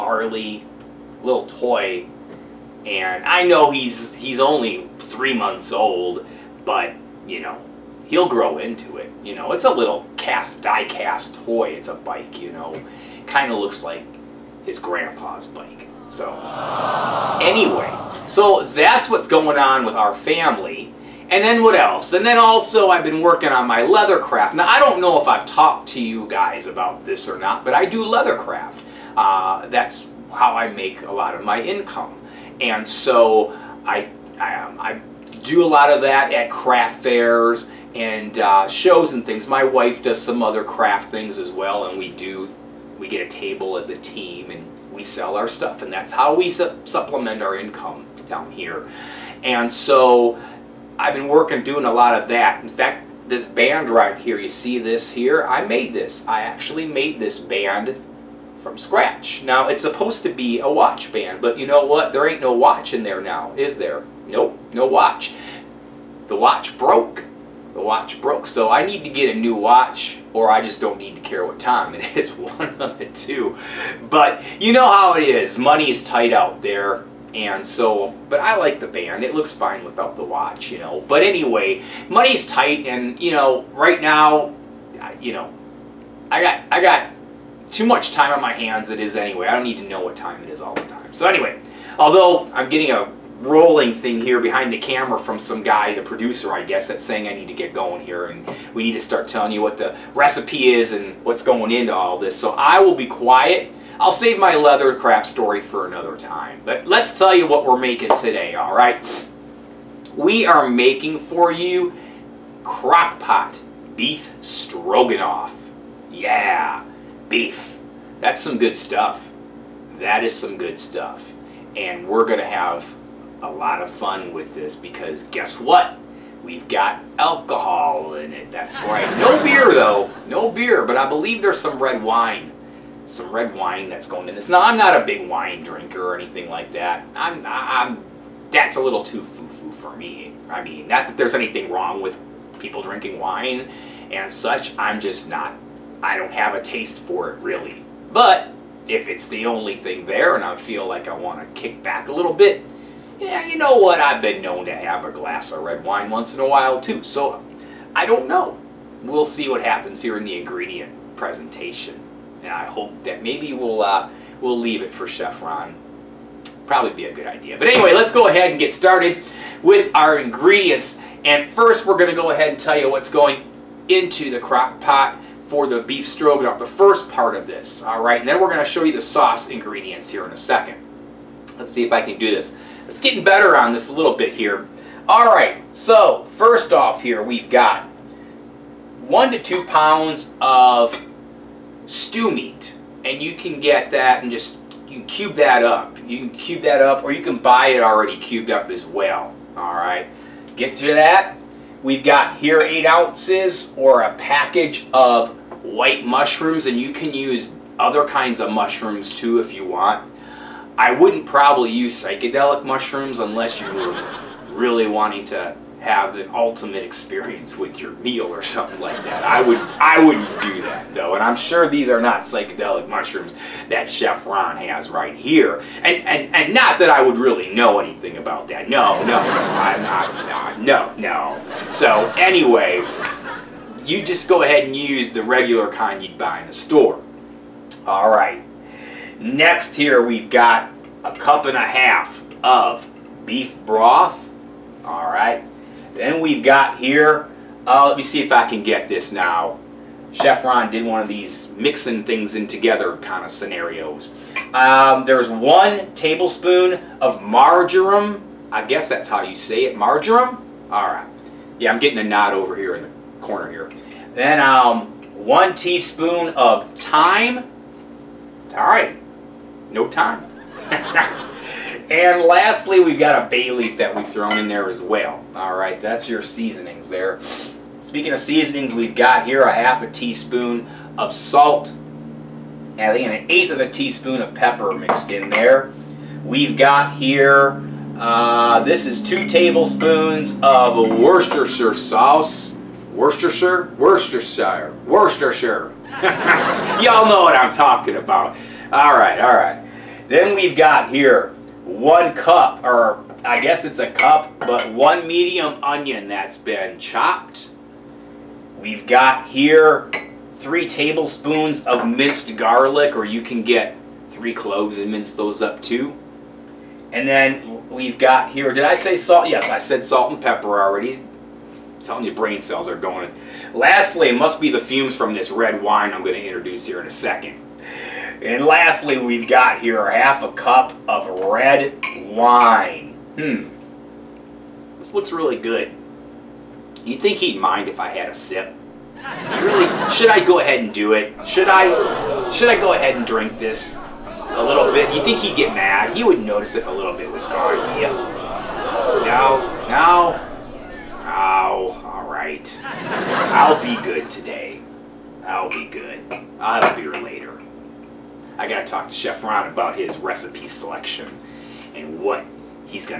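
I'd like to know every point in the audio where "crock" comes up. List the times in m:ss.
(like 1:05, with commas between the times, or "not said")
1:52, 2:54.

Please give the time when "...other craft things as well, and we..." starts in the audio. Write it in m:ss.
0:40.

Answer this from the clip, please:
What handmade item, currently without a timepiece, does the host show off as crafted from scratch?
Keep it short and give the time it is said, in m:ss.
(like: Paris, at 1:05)
watch band, at 1:00.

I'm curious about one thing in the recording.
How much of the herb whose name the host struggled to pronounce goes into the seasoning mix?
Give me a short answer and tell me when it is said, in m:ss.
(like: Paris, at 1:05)
1 tablespoon, at 4:15.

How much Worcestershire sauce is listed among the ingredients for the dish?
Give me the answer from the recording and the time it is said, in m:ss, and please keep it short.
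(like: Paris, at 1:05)
2 tablespoons, at 4:49.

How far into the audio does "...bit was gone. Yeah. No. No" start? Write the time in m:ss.
5:46.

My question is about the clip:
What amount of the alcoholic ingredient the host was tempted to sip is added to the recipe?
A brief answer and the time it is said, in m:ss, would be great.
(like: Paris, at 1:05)
half a cup, at 5:29.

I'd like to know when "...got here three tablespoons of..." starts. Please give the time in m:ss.
5:08.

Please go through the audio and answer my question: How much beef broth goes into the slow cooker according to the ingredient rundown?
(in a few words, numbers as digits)
1.5 cups.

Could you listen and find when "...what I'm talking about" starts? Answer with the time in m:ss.
4:57.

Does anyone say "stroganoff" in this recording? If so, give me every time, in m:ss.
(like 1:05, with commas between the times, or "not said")
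1:54, 2:56.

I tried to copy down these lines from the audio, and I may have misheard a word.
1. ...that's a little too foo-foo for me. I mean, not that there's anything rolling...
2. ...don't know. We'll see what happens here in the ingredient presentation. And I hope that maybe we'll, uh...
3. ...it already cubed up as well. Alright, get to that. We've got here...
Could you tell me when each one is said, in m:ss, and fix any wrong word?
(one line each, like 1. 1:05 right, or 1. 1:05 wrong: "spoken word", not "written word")
1. 2:18 wrong: "wrong", not "rolling"
2. 2:38 right
3. 3:17 right.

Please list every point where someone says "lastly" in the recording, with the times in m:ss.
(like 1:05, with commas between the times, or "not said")
4:32, 5:23, 5:28.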